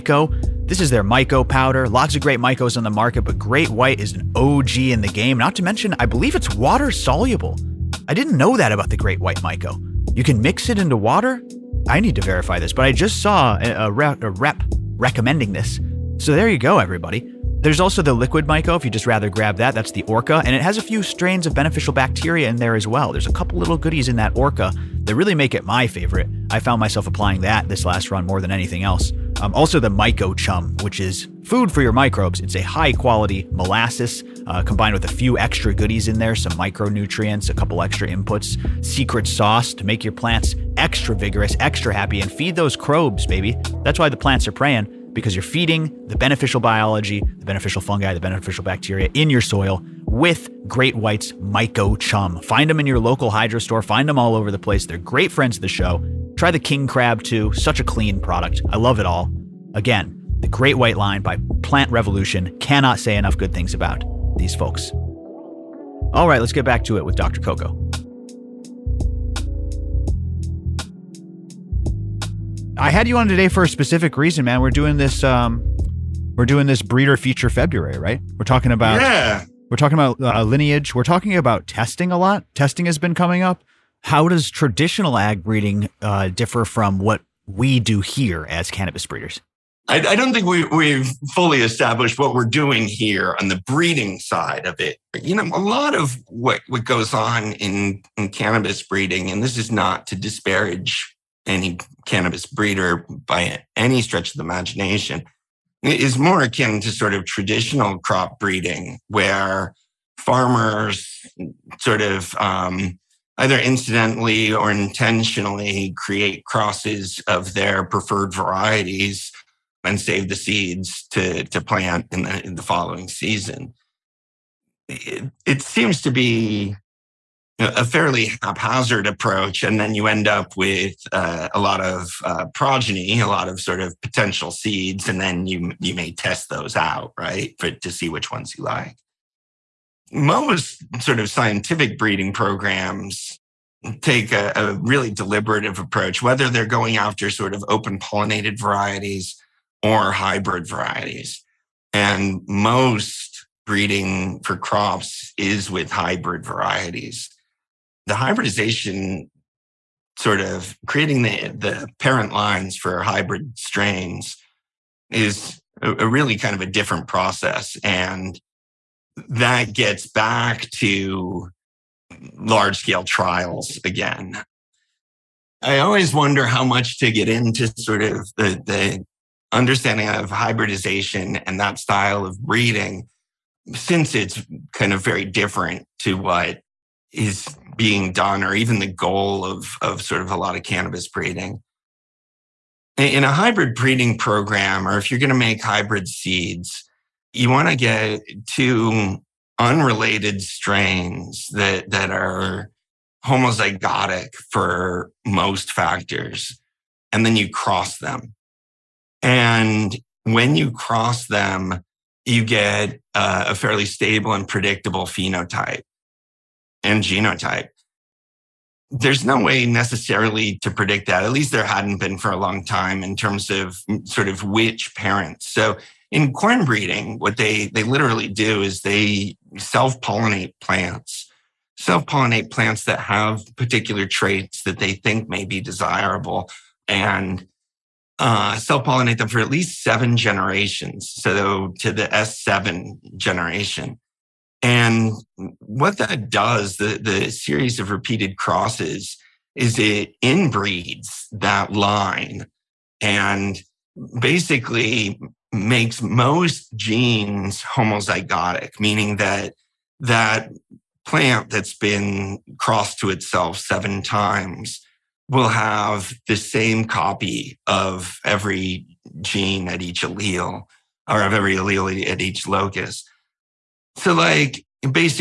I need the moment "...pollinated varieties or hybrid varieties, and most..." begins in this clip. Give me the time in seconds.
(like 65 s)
147 s.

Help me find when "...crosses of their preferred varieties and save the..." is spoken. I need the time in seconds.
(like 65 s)
116 s.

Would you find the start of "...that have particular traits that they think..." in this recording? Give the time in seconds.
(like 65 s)
232 s.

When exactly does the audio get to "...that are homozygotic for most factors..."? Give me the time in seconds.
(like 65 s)
201 s.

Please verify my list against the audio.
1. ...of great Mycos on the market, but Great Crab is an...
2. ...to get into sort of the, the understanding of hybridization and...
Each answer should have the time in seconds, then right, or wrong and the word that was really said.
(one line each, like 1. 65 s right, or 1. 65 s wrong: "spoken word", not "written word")
1. 2 s wrong: "White", not "Crab"
2. 176 s right.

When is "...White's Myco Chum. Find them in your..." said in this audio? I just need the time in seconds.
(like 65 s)
50 s.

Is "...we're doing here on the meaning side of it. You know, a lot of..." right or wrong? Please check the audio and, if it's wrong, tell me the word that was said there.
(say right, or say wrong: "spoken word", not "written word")
wrong: "breeding", not "meaning".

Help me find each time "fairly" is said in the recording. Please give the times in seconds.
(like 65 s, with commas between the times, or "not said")
127 s, 213 s.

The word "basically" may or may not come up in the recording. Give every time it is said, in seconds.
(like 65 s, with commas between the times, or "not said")
254 s.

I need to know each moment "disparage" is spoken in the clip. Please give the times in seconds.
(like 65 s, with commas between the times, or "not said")
100 s.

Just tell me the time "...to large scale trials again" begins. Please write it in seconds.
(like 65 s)
170 s.